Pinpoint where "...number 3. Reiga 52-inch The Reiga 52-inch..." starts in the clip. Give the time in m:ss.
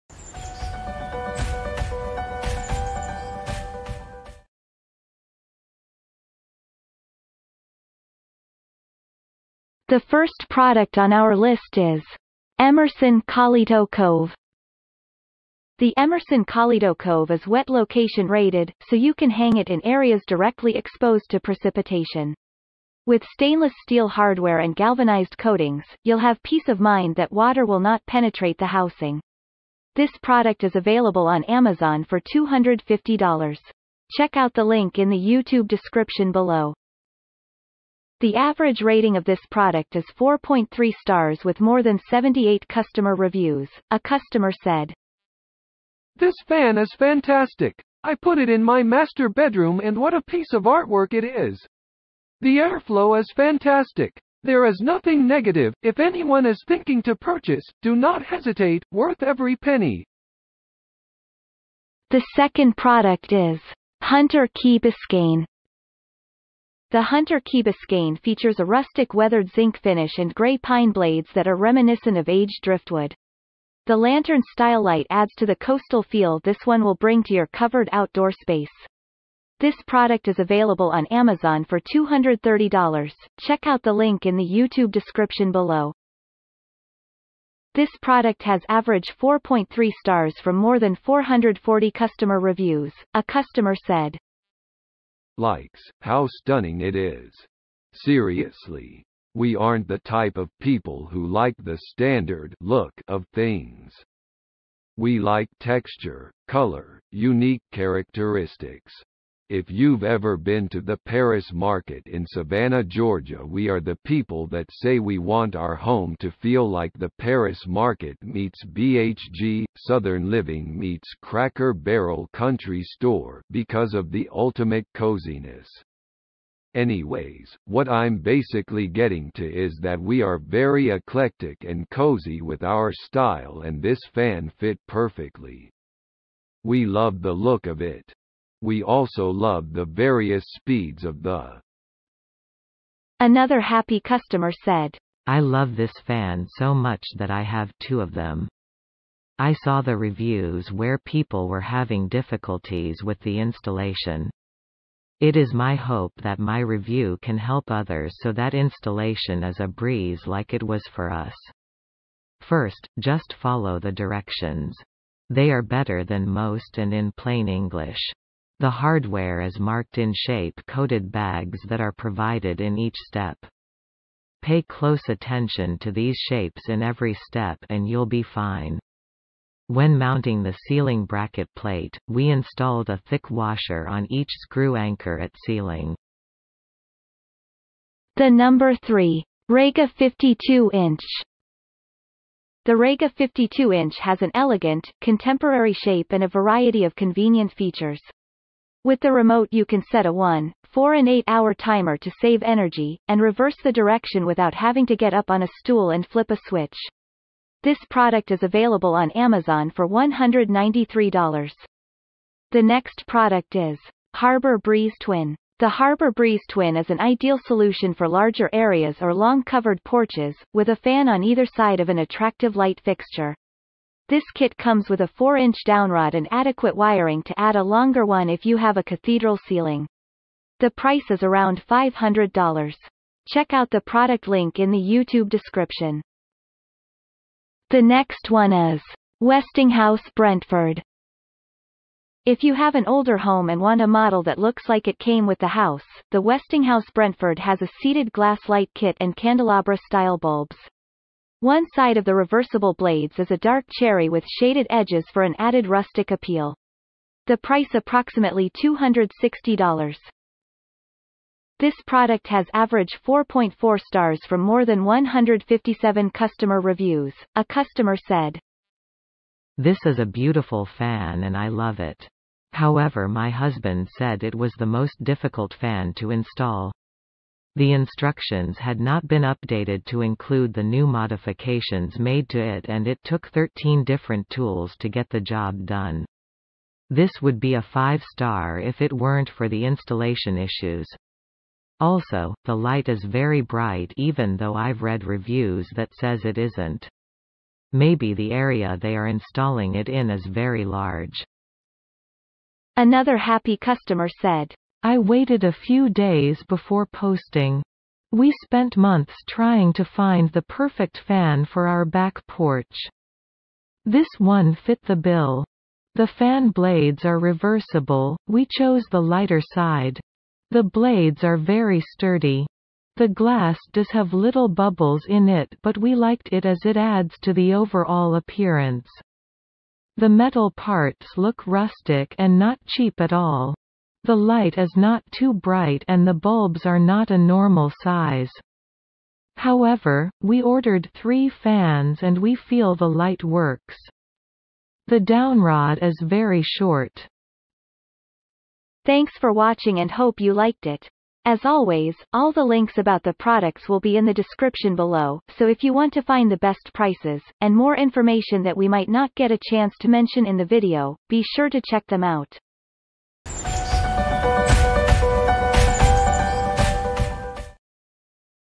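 3:08.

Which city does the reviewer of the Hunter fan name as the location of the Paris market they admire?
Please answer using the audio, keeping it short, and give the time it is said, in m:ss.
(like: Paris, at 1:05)
Savannah, Georgia, at 1:52.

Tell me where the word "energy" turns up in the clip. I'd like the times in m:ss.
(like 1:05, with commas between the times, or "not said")
3:22.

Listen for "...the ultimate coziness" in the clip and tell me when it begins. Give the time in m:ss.
2:04.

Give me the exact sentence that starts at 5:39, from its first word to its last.
However, we ordered three fans and we feel the light works.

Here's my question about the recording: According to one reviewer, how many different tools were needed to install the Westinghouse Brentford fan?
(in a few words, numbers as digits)
13.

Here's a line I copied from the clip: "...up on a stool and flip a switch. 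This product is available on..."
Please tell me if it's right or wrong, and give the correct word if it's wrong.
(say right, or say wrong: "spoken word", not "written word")
right.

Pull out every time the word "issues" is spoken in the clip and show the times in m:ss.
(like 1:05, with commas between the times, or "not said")
4:50.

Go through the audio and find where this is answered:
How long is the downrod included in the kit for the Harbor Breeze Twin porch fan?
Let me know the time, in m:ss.
3:45.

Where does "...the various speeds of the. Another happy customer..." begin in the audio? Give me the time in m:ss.
2:19.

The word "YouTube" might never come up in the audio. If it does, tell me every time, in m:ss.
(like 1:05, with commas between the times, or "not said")
0:35, 1:24, 3:54.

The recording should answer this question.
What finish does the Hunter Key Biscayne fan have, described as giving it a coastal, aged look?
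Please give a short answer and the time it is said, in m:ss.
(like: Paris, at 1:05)
rustic weathered zinc, at 1:08.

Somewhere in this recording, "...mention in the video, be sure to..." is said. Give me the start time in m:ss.
5:59.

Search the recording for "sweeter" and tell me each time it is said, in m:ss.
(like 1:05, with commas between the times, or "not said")
not said.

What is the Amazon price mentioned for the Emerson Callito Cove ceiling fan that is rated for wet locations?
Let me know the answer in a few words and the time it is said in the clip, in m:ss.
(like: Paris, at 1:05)
$250, at 0:32.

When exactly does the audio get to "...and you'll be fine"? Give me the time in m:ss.
2:57.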